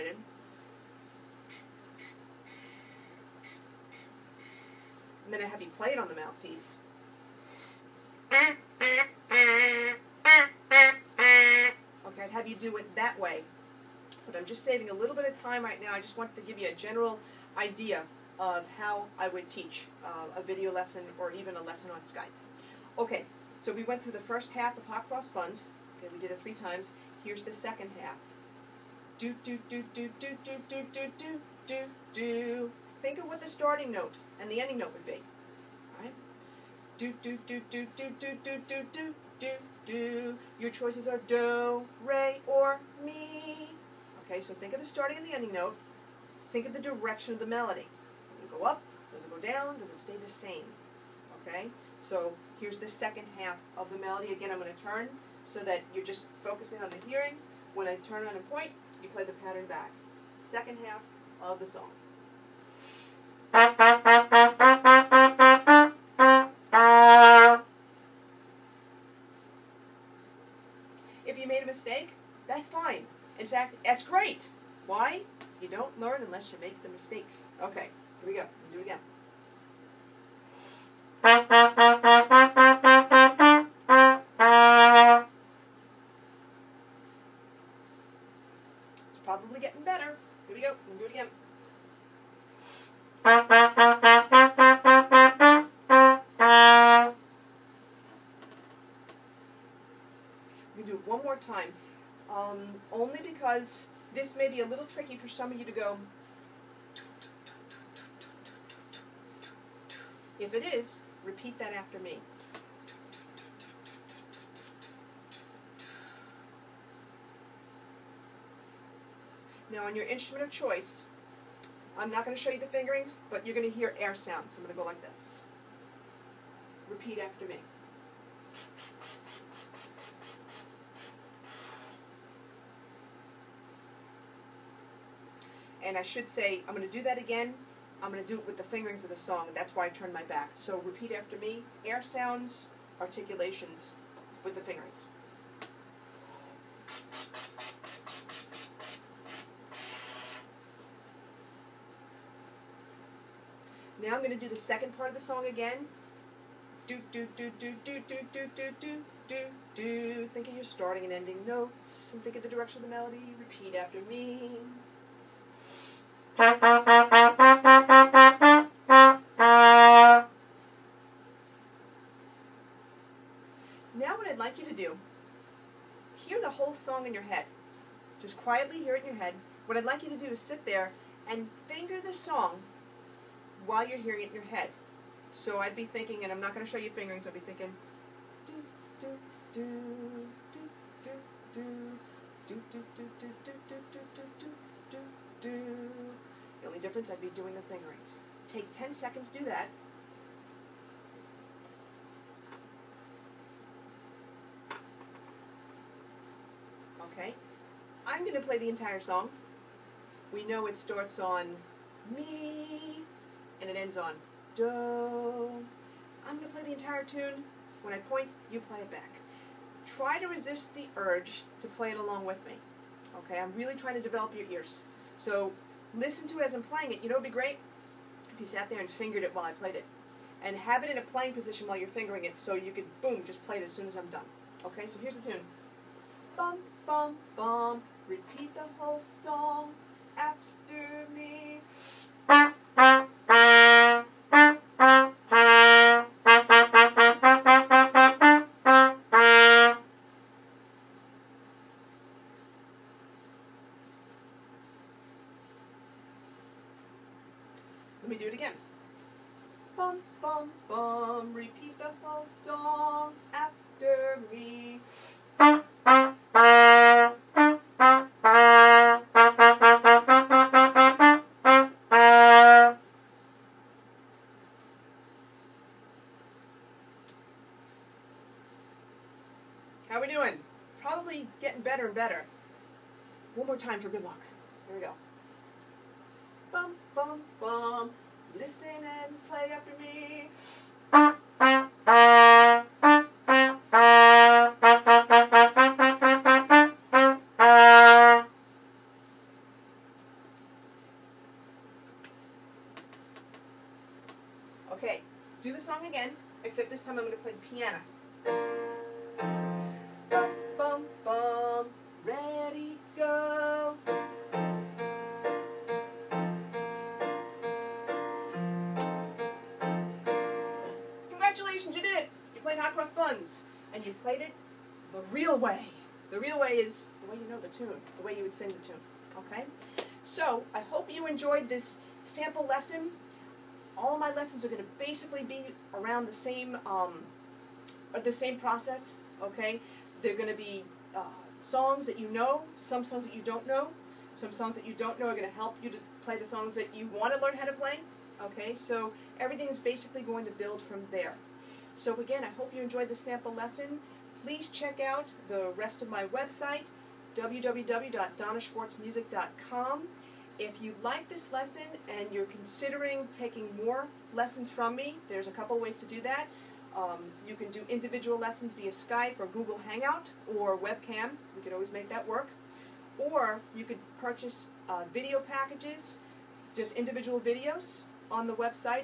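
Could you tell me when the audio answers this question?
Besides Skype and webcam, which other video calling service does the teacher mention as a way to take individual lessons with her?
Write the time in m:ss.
6:09.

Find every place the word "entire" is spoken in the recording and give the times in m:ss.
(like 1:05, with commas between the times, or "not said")
3:28, 3:36.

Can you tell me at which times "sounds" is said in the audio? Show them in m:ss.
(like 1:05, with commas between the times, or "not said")
2:04, 2:22.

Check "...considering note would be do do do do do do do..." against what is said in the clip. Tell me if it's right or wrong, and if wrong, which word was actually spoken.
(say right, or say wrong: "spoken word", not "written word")
wrong: "ending", not "considering".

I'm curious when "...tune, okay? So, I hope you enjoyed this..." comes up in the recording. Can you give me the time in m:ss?
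5:28.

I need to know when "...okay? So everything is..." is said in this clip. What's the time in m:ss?
5:48.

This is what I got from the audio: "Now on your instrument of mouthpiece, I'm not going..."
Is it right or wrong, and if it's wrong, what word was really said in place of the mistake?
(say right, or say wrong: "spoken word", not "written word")
wrong: "choice", not "mouthpiece".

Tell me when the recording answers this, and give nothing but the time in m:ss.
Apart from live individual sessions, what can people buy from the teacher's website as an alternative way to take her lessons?
6:14.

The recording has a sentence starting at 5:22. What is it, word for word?
You played Hot Cross Buns, and you played it the real way.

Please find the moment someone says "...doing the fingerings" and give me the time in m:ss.
3:17.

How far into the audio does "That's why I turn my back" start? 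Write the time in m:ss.
2:19.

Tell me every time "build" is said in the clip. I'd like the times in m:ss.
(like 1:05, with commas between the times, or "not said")
5:50.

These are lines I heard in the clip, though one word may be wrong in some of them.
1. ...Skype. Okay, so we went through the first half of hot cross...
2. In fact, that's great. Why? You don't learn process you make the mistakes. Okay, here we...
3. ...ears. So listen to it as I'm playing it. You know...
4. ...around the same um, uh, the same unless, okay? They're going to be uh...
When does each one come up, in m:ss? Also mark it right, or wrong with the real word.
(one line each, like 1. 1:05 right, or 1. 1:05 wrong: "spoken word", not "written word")
1. 0:22 right
2. 1:13 wrong: "unless", not "process"
3. 3:44 right
4. 5:35 wrong: "process", not "unless".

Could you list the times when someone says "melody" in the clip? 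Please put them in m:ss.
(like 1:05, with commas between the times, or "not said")
0:47, 0:53, 2:42.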